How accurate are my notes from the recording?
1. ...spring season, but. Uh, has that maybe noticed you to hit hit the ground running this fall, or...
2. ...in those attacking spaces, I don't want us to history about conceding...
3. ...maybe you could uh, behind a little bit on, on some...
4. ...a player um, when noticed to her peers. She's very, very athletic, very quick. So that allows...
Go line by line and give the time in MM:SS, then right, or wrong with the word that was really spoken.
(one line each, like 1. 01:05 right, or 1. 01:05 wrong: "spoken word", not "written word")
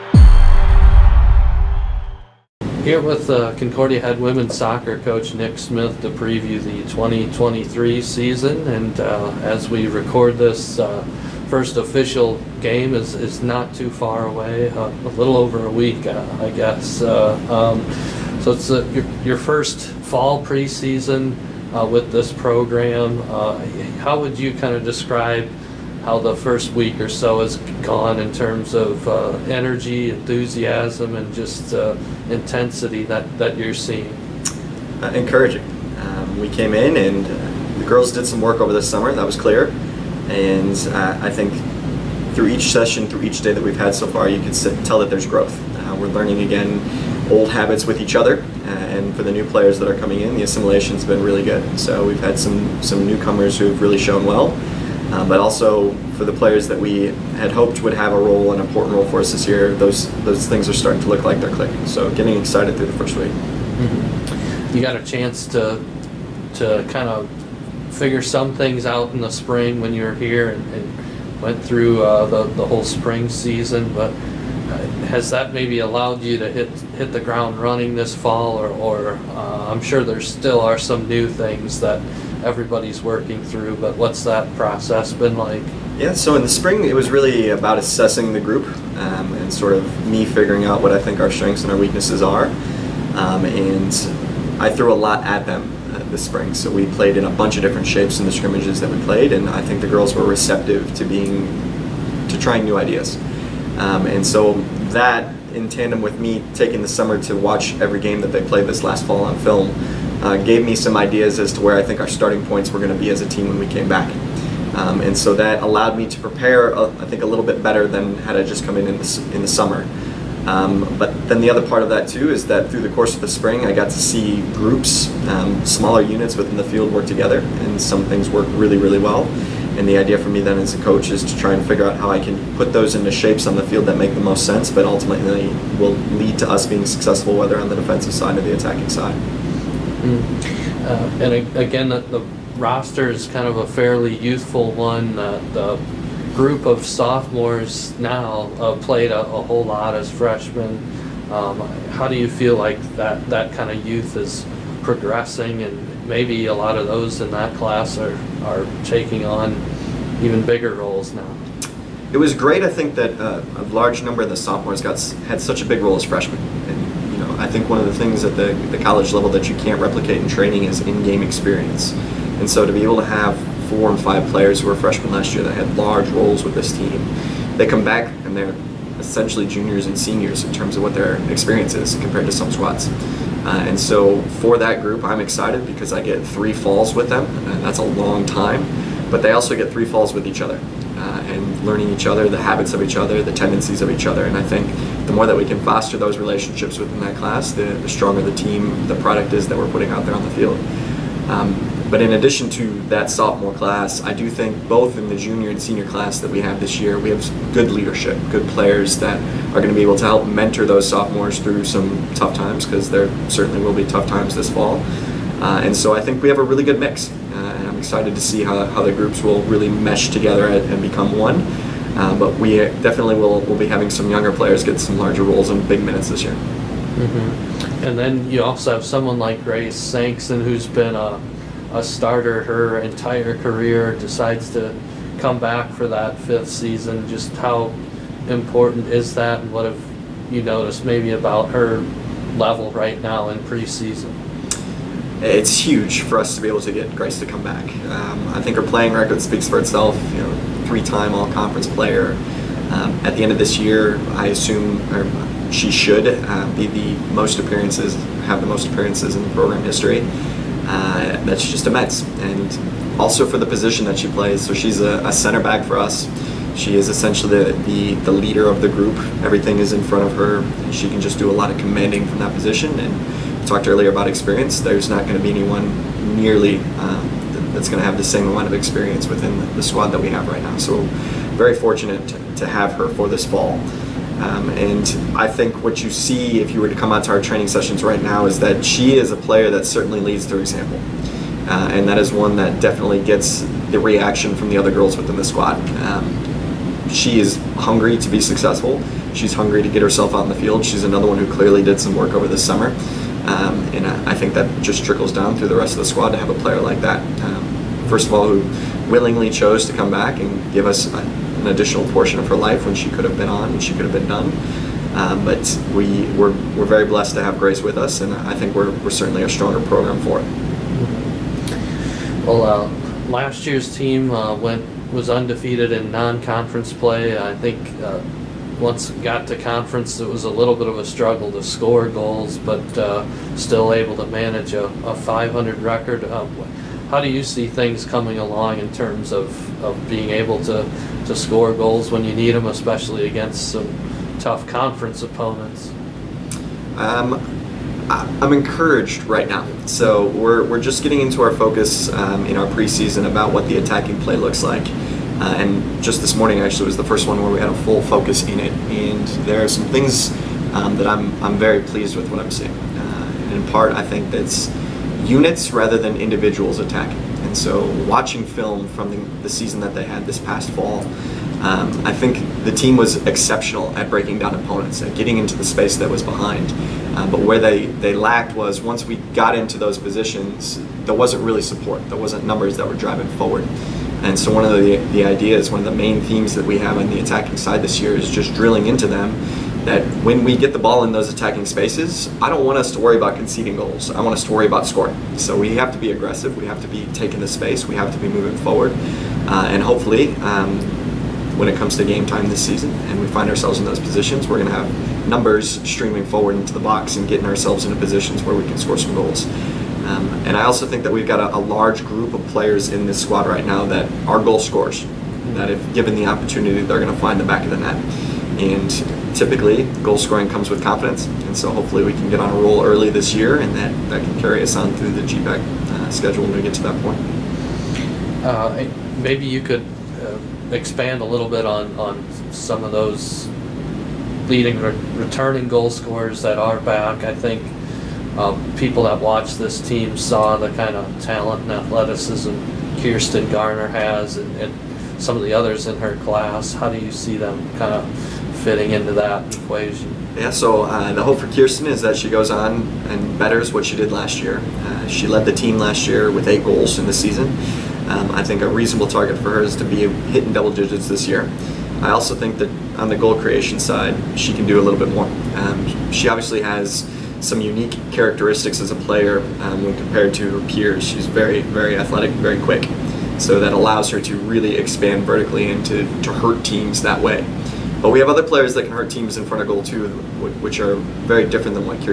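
1. 01:12 wrong: "allowed", not "noticed"
2. 06:30 wrong: "worry", not "history"
3. 07:09 wrong: "expand", not "behind"
4. 07:48 wrong: "compared", not "noticed".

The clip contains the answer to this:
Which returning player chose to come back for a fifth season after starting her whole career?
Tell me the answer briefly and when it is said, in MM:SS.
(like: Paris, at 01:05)
Grace Sankson, at 03:49.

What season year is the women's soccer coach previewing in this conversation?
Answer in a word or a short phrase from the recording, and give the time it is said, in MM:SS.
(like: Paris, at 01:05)
2023, at 00:06.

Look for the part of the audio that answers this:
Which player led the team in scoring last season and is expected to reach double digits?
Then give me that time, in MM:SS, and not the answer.
07:22.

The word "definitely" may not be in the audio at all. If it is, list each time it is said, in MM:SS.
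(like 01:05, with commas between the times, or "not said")
03:42, 04:52.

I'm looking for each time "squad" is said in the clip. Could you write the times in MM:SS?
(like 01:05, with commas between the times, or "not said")
03:02, 04:39, 04:55, 05:05, 06:53.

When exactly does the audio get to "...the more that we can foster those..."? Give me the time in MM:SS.
03:15.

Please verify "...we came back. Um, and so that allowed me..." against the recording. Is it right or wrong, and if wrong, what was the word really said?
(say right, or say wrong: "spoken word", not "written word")
right.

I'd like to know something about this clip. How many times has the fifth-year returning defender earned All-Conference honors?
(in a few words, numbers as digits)
3.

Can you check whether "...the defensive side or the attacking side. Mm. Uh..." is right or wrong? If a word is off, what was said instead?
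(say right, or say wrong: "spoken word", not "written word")
right.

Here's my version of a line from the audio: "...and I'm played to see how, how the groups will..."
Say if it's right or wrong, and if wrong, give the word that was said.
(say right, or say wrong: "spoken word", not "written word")
wrong: "excited", not "played".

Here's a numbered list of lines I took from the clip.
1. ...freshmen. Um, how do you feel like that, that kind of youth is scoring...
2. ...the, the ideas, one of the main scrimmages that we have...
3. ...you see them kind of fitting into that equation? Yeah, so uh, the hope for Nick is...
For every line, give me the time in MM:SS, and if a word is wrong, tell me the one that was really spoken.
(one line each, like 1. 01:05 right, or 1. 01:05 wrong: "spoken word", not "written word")
1. 02:30 wrong: "progressing", not "scoring"
2. 06:24 wrong: "themes", not "scrimmages"
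3. 07:26 wrong: "Kirsten", not "Nick".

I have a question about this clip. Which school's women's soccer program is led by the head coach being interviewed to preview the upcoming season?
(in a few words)
Concordia.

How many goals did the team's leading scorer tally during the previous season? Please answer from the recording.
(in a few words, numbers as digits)
8.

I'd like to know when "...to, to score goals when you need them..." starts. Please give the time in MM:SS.
05:40.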